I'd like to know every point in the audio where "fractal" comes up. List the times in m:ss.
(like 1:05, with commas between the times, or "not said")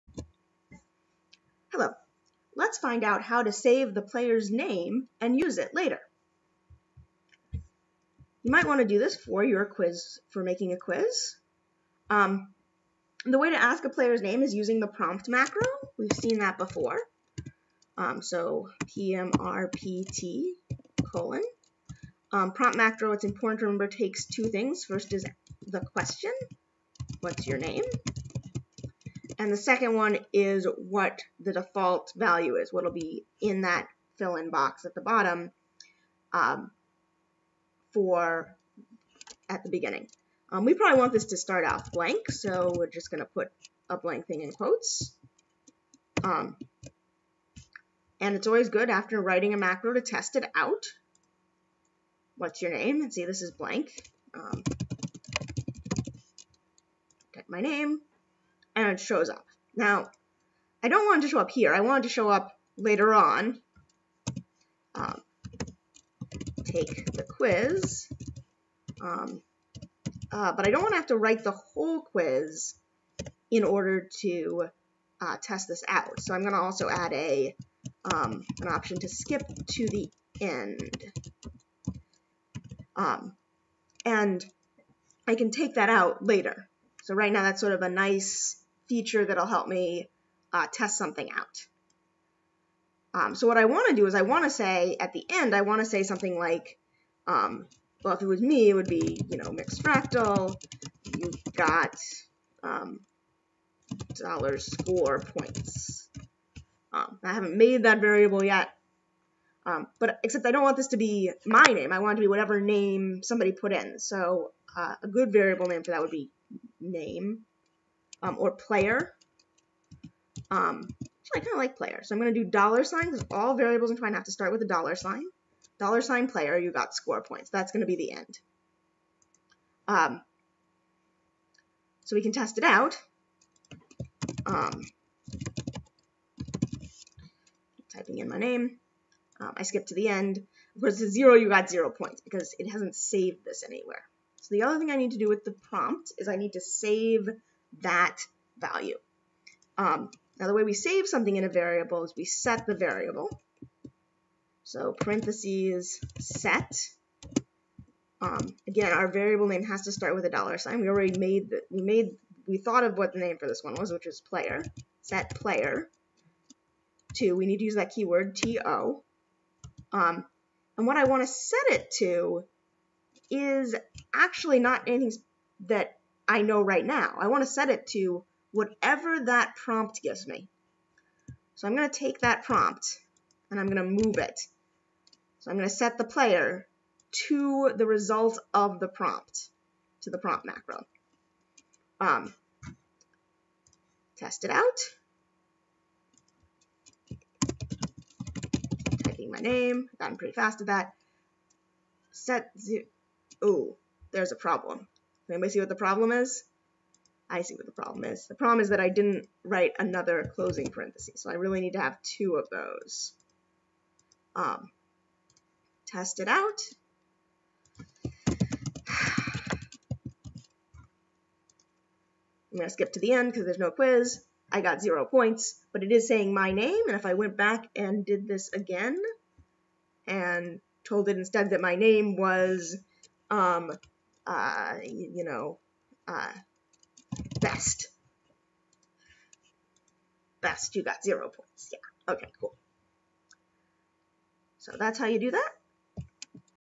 1:39.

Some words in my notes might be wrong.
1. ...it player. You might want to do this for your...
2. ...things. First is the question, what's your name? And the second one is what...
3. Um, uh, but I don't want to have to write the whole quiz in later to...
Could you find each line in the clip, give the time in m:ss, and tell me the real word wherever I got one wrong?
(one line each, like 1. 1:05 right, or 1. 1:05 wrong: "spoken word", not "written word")
1. 0:05 wrong: "later", not "player"
2. 0:24 right
3. 1:08 wrong: "order", not "later".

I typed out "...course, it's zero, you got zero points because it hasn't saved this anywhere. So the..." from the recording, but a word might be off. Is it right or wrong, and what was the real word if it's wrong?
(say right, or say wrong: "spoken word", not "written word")
right.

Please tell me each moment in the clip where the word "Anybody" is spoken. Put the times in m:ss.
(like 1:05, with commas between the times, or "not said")
3:25.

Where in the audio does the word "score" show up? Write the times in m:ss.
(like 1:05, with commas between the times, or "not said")
1:44, 2:06.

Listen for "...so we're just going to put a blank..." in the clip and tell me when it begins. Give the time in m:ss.
0:42.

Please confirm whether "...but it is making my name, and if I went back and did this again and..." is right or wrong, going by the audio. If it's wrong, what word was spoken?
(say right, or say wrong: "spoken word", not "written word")
wrong: "saying", not "making".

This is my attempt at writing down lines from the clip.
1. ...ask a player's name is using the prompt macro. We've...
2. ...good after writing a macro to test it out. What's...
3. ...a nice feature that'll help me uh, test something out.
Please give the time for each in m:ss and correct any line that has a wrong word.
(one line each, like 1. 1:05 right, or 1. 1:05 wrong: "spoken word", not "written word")
1. 0:13 right
2. 0:48 right
3. 1:27 right.